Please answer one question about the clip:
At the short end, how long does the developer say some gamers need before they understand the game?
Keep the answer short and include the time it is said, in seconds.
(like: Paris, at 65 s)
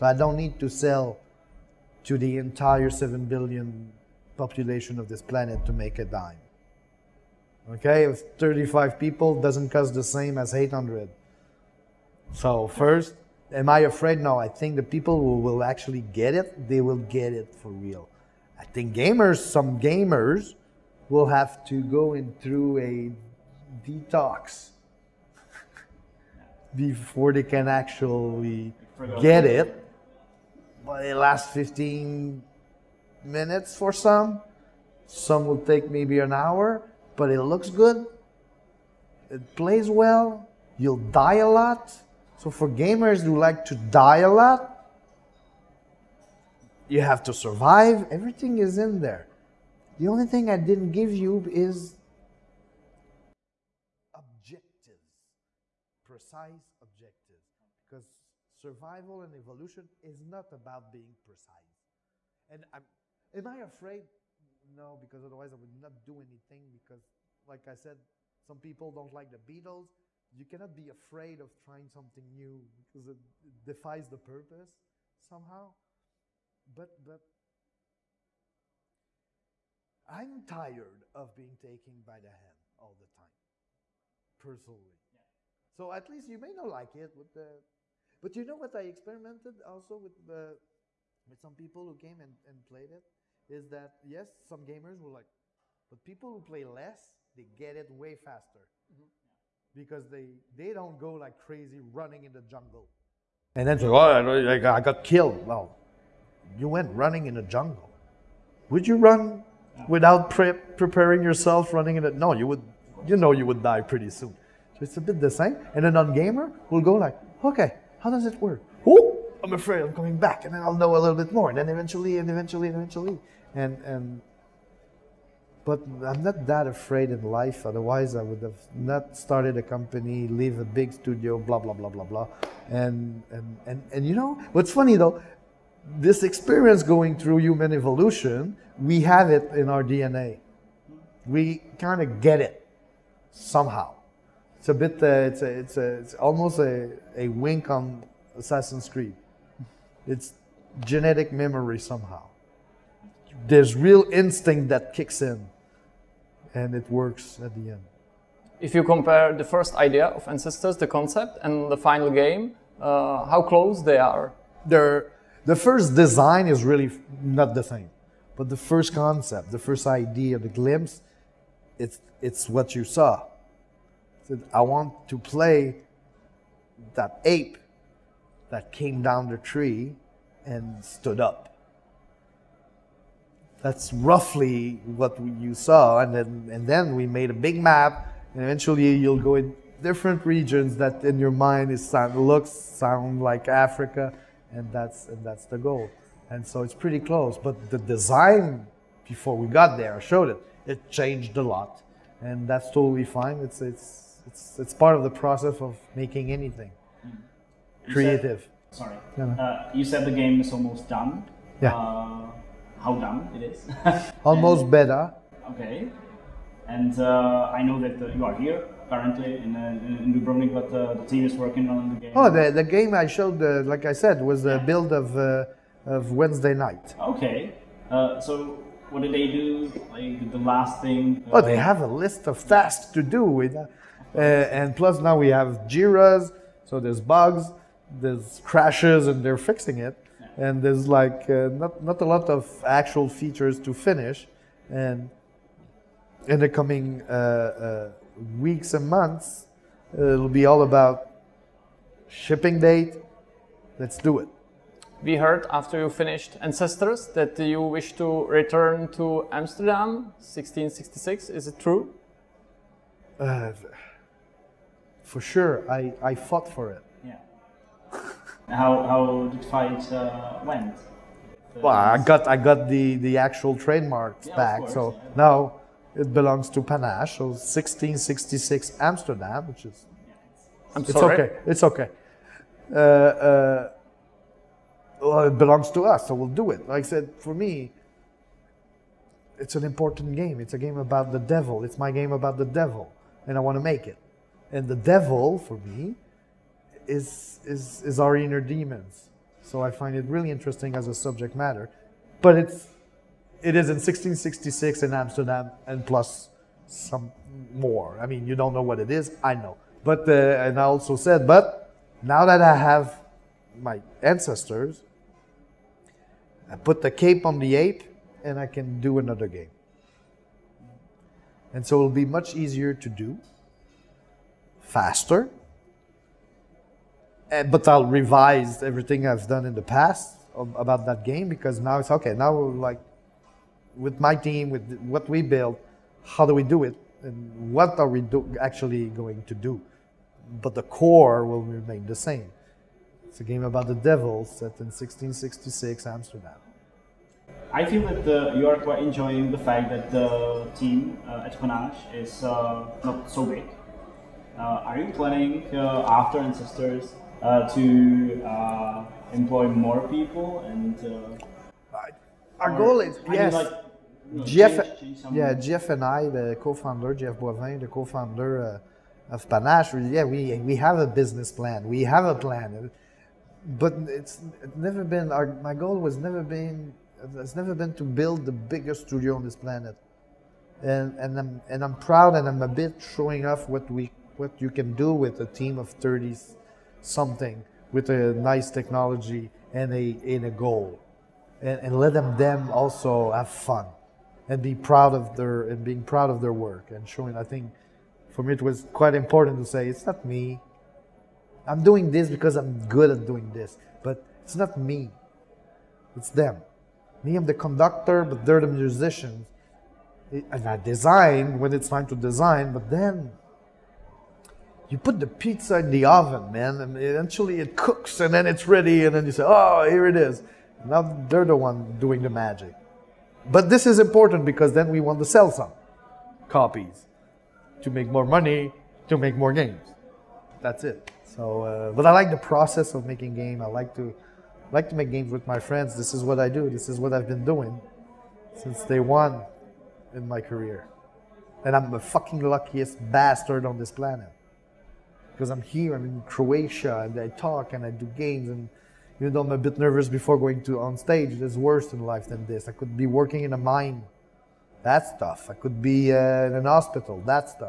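15 minutes, at 31 s.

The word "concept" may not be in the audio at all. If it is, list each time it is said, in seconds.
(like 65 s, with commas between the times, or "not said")
160 s, 168 s.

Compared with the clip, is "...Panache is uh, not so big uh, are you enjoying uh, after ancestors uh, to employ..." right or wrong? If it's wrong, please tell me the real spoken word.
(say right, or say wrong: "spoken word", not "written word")
wrong: "planning", not "enjoying".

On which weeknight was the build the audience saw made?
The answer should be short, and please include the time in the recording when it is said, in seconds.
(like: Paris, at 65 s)
Wednesday, at 226 s.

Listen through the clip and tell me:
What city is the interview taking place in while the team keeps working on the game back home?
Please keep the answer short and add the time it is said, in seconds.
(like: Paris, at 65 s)
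Dubrovnik, at 220 s.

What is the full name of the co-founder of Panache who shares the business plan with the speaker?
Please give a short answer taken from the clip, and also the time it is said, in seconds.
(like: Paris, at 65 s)
Jeff Boivin, at 366 s.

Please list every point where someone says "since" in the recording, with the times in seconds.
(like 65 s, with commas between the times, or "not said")
438 s.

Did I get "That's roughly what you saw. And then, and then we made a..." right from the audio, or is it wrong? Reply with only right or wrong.
right.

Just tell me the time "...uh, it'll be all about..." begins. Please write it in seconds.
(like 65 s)
249 s.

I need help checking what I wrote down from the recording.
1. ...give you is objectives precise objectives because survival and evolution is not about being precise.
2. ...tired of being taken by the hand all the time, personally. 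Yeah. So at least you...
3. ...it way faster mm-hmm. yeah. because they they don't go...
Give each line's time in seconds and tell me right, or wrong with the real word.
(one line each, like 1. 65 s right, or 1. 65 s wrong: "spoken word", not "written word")
1. 50 s right
2. 80 s right
3. 97 s right.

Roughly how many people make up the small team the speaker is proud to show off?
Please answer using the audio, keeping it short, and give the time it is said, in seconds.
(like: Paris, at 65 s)
30 something, at 385 s.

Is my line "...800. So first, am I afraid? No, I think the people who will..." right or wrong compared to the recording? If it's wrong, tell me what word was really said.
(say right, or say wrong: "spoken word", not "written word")
right.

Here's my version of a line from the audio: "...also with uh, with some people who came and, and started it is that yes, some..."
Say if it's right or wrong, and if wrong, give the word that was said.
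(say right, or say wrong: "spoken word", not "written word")
wrong: "played", not "started".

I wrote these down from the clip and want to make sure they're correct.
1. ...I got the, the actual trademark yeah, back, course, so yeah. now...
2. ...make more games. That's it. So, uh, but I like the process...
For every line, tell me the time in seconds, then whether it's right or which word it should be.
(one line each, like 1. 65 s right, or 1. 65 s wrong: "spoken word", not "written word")
1. 272 s right
2. 428 s right.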